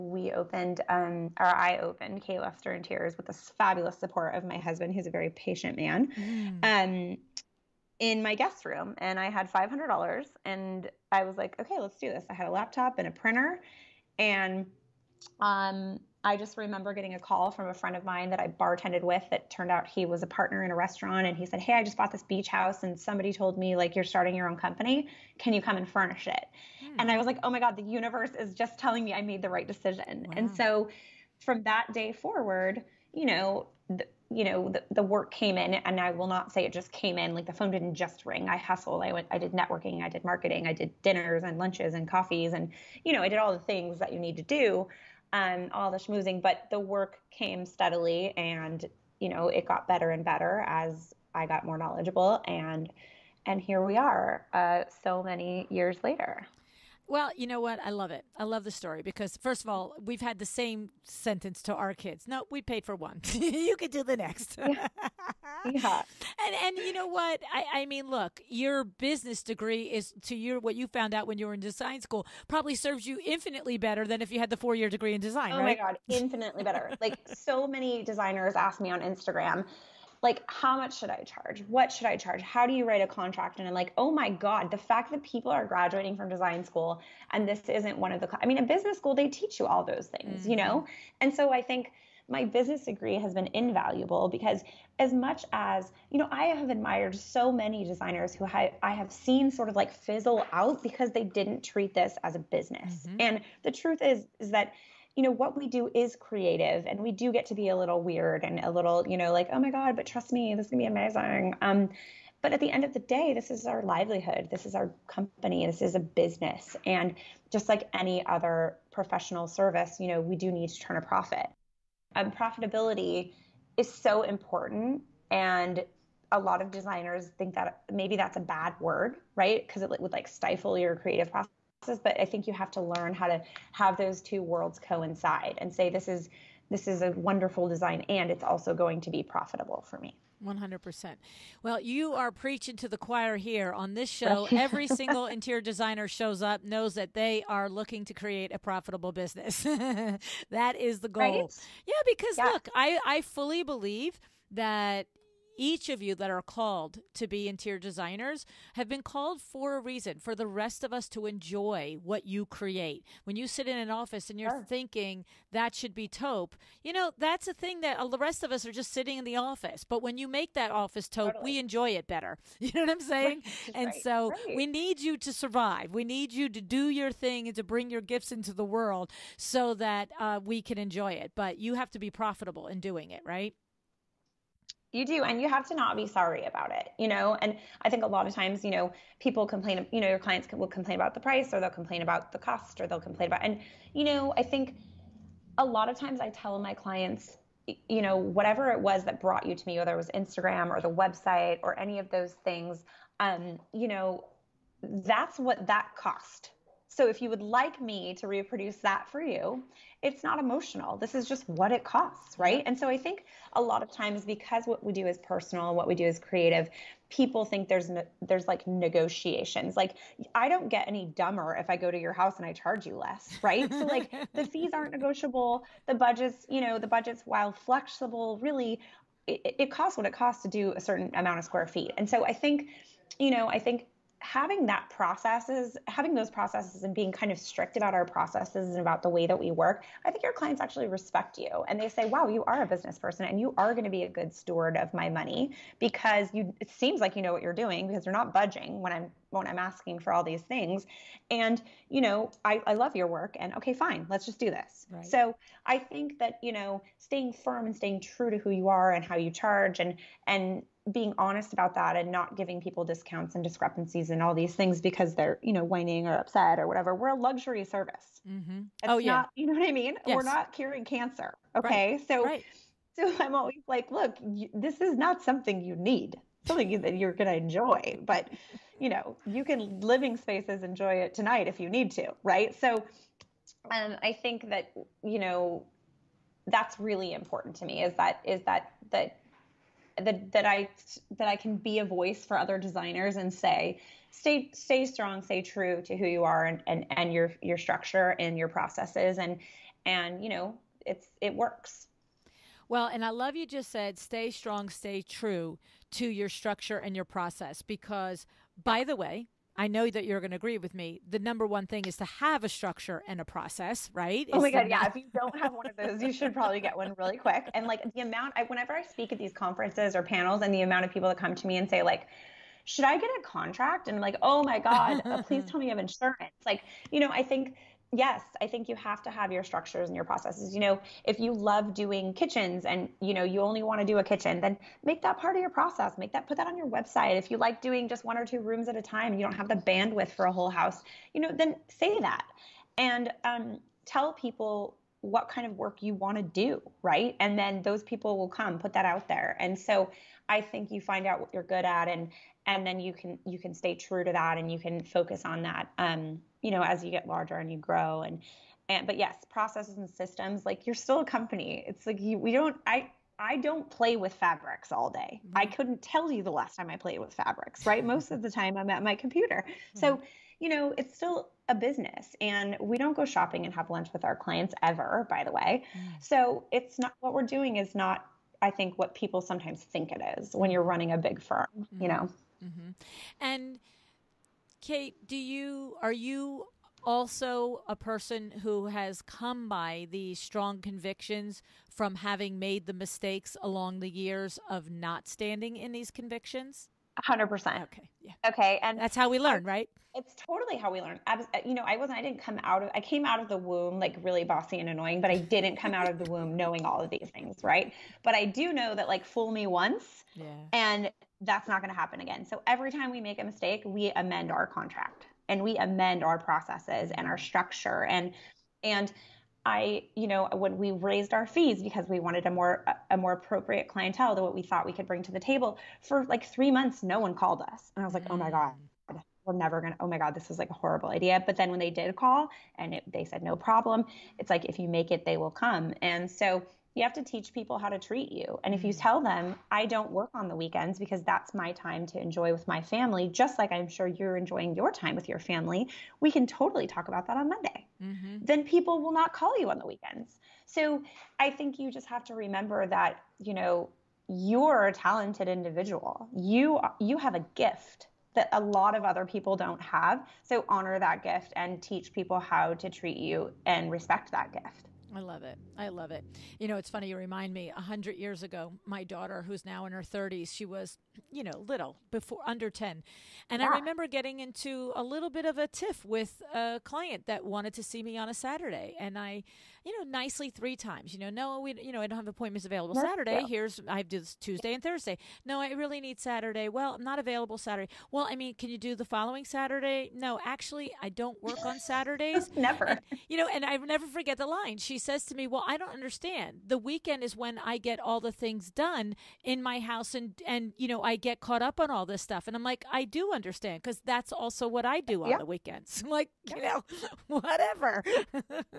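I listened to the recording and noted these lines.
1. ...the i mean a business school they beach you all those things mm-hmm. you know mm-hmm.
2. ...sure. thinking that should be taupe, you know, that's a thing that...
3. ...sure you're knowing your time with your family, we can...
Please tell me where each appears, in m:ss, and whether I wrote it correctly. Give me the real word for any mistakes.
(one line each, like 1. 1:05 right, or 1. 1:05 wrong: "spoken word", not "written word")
1. 1:28 wrong: "teach", not "beach"
2. 2:44 right
3. 7:23 wrong: "enjoying", not "knowing".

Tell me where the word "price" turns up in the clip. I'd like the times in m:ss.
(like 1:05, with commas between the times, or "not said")
3:11.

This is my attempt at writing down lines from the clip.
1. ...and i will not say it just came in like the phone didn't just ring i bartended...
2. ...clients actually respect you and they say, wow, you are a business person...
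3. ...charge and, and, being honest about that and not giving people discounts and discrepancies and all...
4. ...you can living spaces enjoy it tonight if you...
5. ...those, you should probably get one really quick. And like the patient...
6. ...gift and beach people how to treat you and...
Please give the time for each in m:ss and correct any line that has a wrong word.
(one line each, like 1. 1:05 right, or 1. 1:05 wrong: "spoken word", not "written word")
1. 0:35 wrong: "hustled", not "bartended"
2. 4:00 right
3. 4:19 right
4. 4:39 right
5. 5:15 wrong: "amount", not "patient"
6. 7:41 wrong: "teach", not "beach".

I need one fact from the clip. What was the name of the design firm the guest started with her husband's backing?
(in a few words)
Kate Lester Interiors.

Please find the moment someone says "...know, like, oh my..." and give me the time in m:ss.
1:49.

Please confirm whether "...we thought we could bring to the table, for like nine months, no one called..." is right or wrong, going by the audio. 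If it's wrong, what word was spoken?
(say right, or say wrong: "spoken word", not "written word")
wrong: "three", not "nine".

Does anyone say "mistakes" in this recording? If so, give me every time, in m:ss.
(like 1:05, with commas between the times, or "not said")
6:32, 6:53.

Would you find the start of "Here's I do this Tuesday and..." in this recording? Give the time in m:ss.
8:03.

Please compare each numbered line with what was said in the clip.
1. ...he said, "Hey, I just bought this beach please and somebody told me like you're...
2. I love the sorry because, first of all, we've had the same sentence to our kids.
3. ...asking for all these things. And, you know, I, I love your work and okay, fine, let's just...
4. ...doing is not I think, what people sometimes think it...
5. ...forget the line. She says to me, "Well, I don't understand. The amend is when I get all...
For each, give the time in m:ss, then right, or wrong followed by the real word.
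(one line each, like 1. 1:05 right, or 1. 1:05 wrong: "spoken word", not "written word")
1. 0:21 wrong: "house", not "please"
2. 0:58 wrong: "story", not "sorry"
3. 4:09 right
4. 6:17 right
5. 8:13 wrong: "weekend", not "amend".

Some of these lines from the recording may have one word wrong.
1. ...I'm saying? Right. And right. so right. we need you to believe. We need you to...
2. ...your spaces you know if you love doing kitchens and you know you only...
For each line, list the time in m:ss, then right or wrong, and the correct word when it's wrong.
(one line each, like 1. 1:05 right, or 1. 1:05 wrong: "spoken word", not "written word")
1. 2:52 wrong: "survive", not "believe"
2. 5:29 wrong: "processes", not "spaces".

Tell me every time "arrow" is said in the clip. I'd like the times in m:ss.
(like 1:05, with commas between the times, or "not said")
not said.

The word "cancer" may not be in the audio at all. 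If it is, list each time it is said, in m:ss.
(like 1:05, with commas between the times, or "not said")
4:30.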